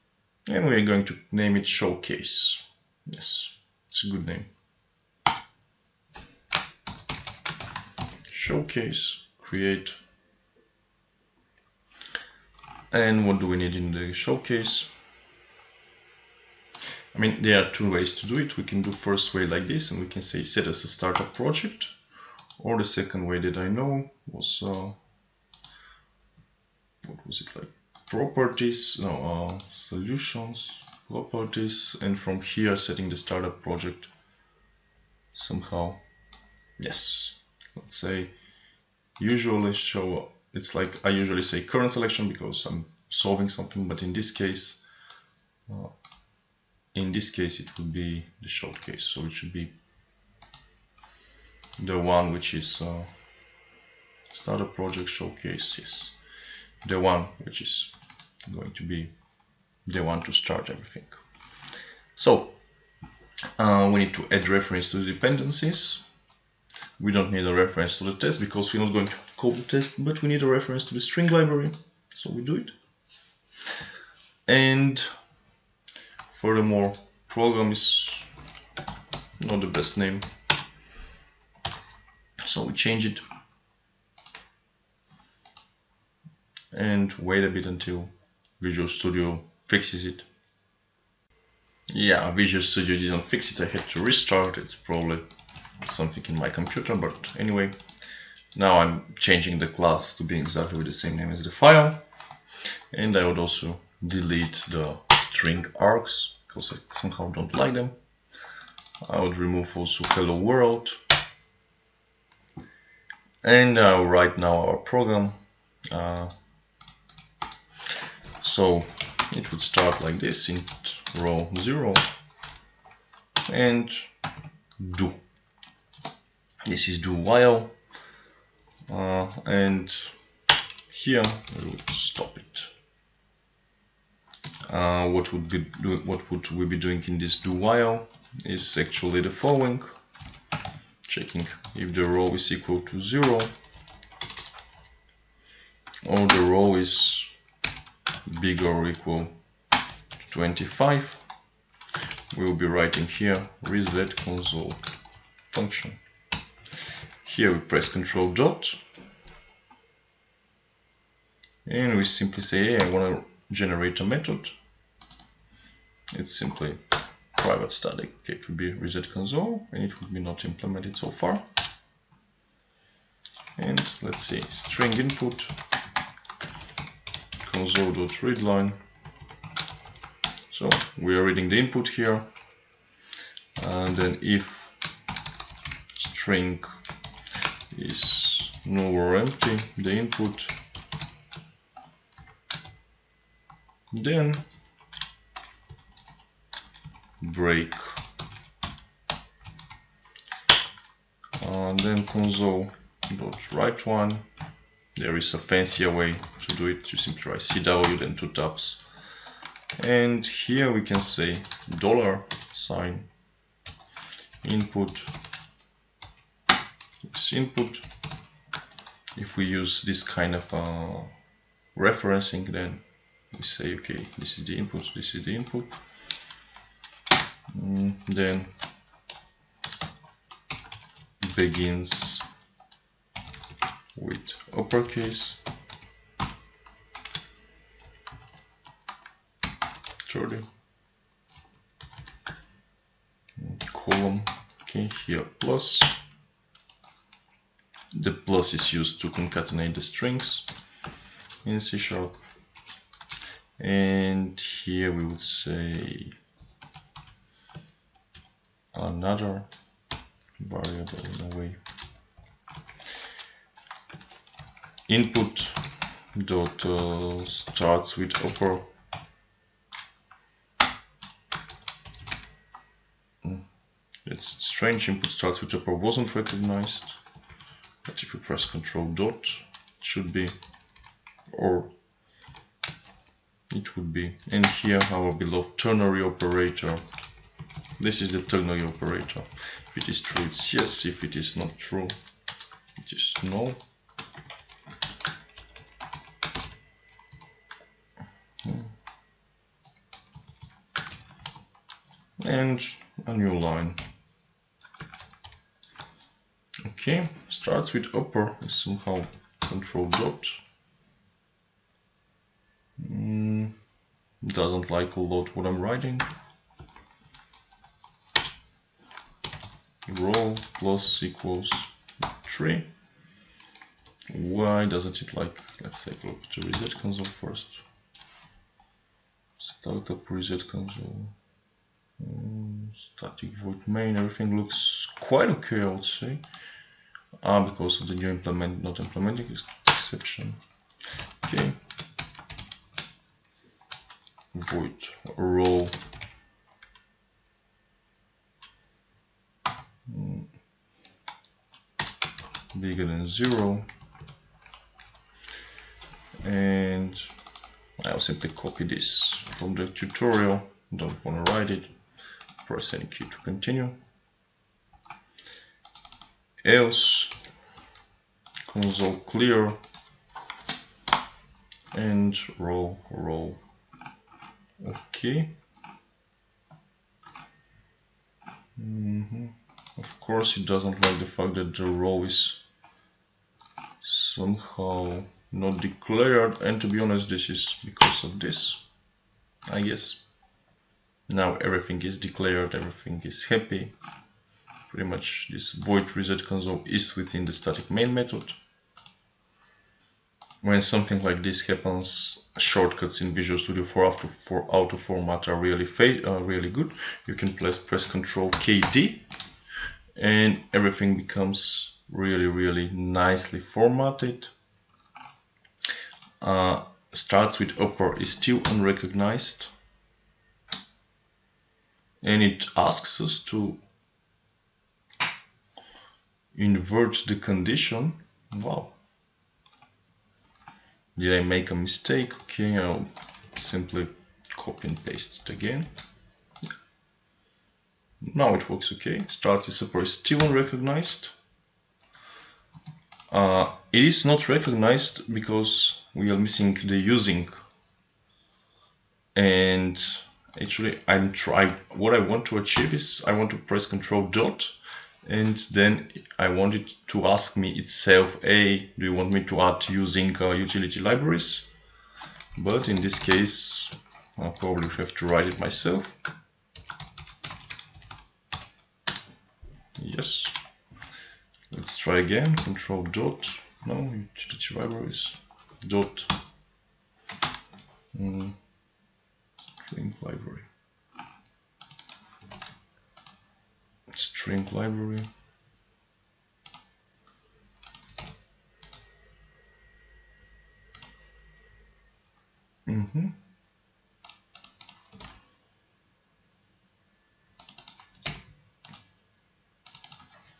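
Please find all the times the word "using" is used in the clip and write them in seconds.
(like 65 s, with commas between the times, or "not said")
446 s, 459 s.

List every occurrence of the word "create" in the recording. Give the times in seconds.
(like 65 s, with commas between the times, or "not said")
9 s.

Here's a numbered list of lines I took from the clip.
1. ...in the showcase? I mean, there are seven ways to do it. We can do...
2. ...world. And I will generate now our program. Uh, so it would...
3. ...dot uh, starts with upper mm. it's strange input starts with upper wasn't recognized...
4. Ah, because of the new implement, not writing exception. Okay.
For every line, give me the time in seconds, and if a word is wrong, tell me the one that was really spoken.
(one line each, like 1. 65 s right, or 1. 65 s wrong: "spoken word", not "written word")
1. 13 s wrong: "two", not "seven"
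2. 110 s wrong: "write", not "generate"
3. 266 s right
4. 337 s wrong: "implementing", not "writing".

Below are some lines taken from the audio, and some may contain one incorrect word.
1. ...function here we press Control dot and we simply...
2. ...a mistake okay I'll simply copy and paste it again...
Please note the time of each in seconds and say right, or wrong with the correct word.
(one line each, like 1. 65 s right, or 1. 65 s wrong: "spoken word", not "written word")
1. 155 s right
2. 431 s right.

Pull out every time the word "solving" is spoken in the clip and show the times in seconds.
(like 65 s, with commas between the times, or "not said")
43 s.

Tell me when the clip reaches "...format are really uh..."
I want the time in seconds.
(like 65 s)
404 s.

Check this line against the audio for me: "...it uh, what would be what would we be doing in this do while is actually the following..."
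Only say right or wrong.
right.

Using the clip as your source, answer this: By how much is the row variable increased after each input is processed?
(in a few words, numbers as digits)
3.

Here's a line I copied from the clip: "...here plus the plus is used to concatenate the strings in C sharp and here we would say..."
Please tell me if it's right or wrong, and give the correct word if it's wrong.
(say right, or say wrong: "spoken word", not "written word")
right.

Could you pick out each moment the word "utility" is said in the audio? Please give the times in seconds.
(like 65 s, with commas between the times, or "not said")
460 s, 473 s.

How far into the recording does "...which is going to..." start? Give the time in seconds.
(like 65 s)
57 s.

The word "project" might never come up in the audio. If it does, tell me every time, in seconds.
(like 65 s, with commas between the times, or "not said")
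21 s, 33 s, 54 s.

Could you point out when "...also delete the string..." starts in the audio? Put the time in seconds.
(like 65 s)
103 s.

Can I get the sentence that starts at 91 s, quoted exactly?
Yeah, Visual Studio didn't fix it, I had to restart, it's probably something in my computer, but anyway.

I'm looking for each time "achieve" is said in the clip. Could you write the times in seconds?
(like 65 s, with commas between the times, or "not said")
452 s.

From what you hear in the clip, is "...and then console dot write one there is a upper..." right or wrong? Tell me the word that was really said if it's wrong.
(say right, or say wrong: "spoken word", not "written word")
wrong: "fancier", not "upper".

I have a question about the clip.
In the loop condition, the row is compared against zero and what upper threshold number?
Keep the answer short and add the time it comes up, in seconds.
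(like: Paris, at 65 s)
25, at 150 s.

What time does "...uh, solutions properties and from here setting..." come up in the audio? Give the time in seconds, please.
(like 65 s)
29 s.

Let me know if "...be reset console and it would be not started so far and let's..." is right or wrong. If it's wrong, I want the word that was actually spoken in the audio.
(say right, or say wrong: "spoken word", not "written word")
wrong: "implemented", not "started".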